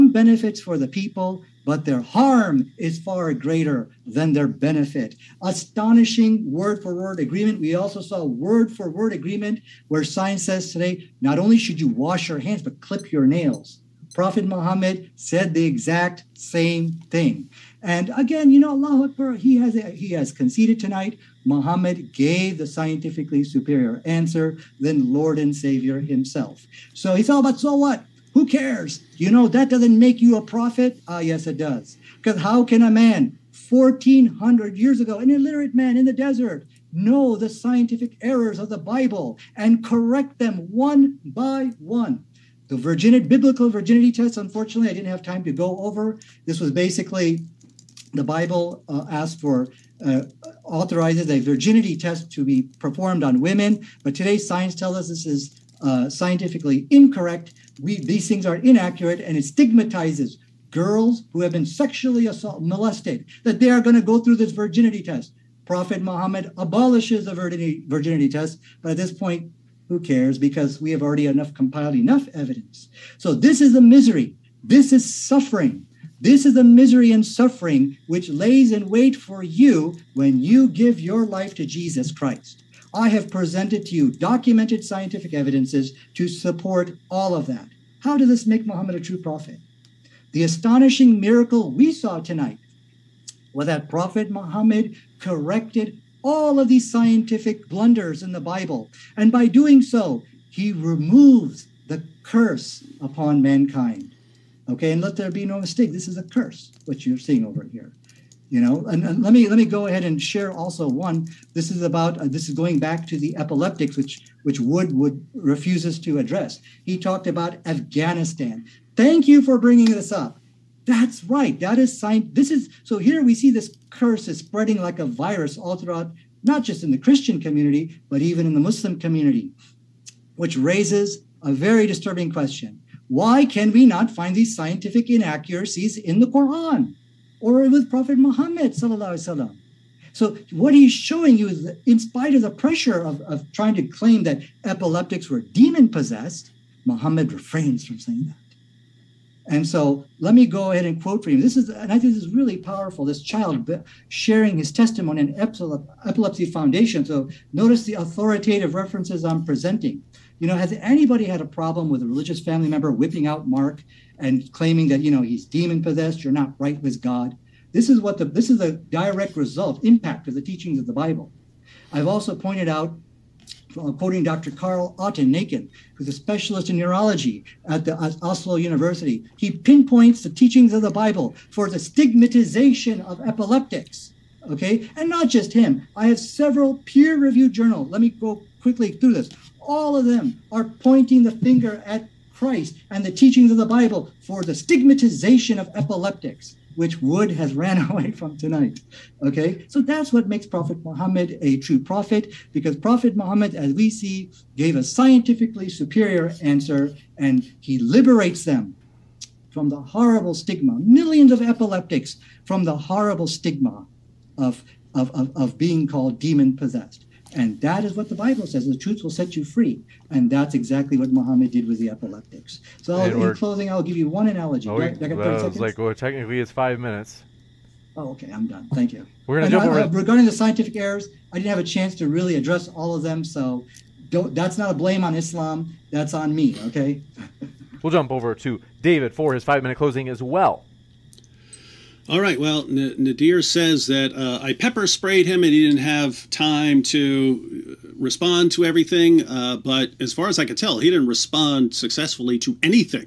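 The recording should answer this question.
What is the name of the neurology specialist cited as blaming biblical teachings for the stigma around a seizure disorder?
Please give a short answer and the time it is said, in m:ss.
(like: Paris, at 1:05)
Karl Otto Nakken, at 2:54.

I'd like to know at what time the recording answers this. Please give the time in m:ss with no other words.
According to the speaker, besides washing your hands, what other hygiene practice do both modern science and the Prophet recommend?
0:12.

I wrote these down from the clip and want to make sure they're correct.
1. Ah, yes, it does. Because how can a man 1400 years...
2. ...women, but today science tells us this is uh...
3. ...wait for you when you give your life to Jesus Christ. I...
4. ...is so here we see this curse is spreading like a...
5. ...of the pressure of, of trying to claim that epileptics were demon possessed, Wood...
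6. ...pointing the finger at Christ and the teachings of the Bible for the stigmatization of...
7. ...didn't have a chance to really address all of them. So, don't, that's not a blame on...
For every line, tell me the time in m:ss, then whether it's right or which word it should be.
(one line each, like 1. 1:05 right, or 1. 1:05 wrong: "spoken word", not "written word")
1. 0:31 right
2. 0:53 right
3. 1:18 right
4. 2:02 right
5. 2:22 wrong: "Muhammad", not "Wood"
6. 3:10 right
7. 3:51 right.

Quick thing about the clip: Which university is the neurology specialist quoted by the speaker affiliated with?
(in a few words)
Oslo University.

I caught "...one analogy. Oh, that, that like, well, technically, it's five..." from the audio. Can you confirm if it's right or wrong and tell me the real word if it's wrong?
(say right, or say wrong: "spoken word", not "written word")
right.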